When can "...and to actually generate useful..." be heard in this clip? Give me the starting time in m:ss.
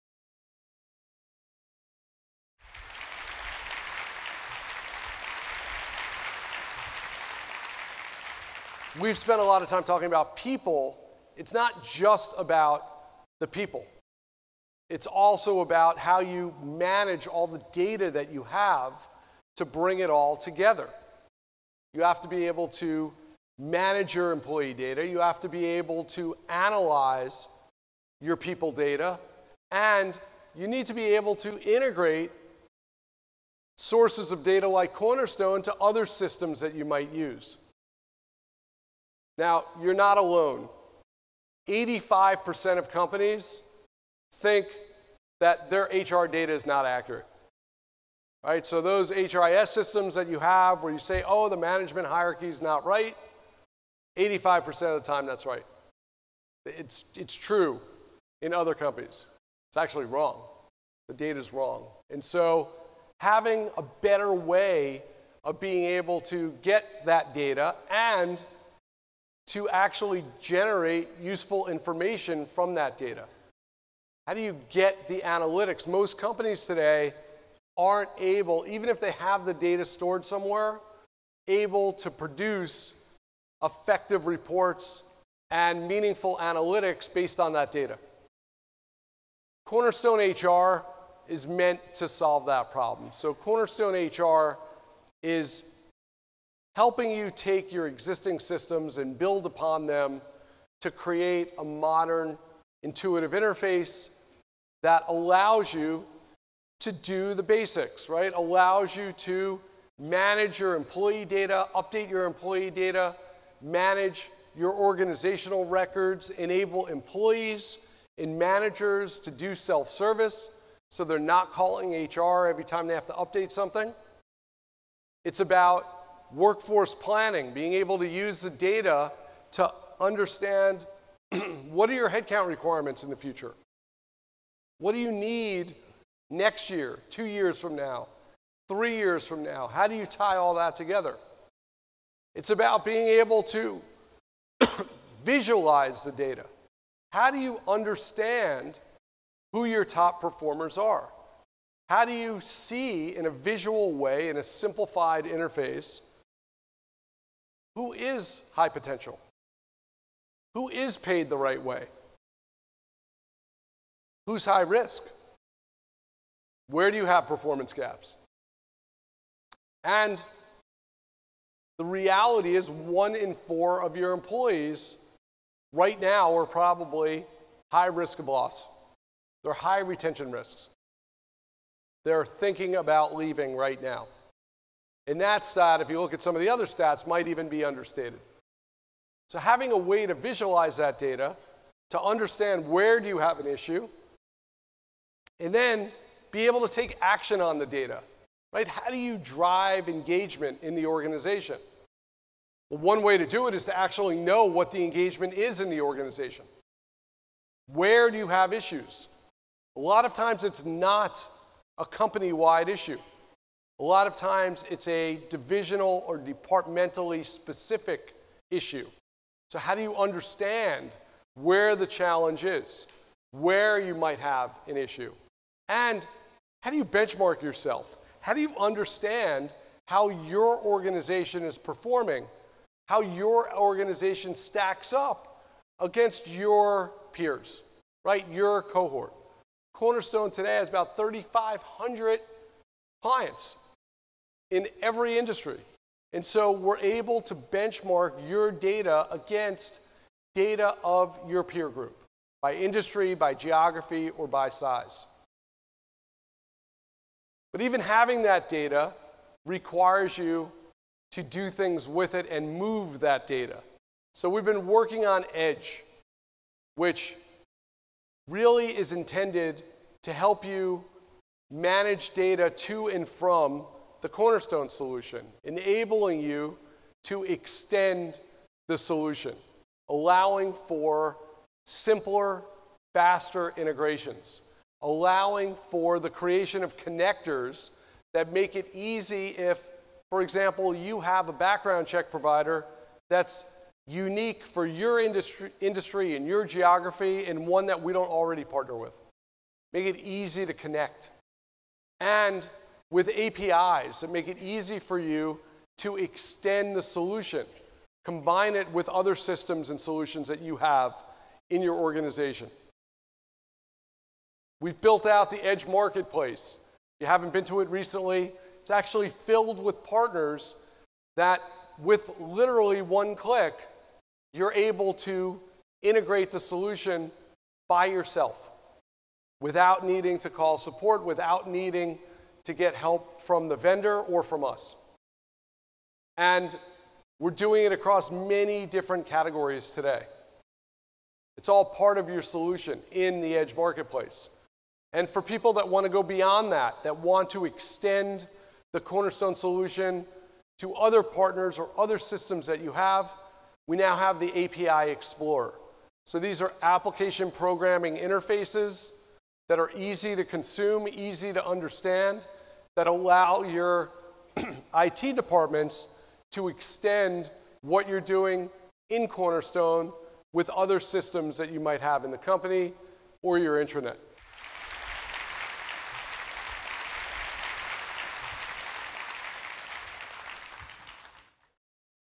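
1:07.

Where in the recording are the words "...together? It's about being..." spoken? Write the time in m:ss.
2:20.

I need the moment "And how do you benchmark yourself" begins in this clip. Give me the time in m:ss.
3:45.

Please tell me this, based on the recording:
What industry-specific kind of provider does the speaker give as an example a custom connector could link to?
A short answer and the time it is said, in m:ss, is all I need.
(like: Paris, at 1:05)
background check provider, at 4:51.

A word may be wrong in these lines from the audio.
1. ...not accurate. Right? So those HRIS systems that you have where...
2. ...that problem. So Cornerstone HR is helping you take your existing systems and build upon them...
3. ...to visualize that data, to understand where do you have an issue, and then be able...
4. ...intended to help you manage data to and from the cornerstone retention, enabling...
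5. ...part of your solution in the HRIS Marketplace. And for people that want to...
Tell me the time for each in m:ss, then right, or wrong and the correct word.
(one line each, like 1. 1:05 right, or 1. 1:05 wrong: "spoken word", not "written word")
1. 0:46 right
2. 1:32 right
3. 3:10 right
4. 4:28 wrong: "solution", not "retention"
5. 5:41 wrong: "Edge", not "HRIS".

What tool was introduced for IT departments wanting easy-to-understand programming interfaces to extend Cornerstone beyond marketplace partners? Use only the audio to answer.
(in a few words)
API Explorer.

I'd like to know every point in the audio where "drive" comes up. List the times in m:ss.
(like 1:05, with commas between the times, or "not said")
3:19.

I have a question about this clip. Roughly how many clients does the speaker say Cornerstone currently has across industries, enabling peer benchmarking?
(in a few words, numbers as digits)
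3,500.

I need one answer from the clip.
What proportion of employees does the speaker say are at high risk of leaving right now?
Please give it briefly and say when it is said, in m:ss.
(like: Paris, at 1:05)
one in four, at 2:52.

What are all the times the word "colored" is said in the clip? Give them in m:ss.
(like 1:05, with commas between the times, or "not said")
not said.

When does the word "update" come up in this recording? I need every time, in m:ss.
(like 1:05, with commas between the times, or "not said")
1:51, 2:03.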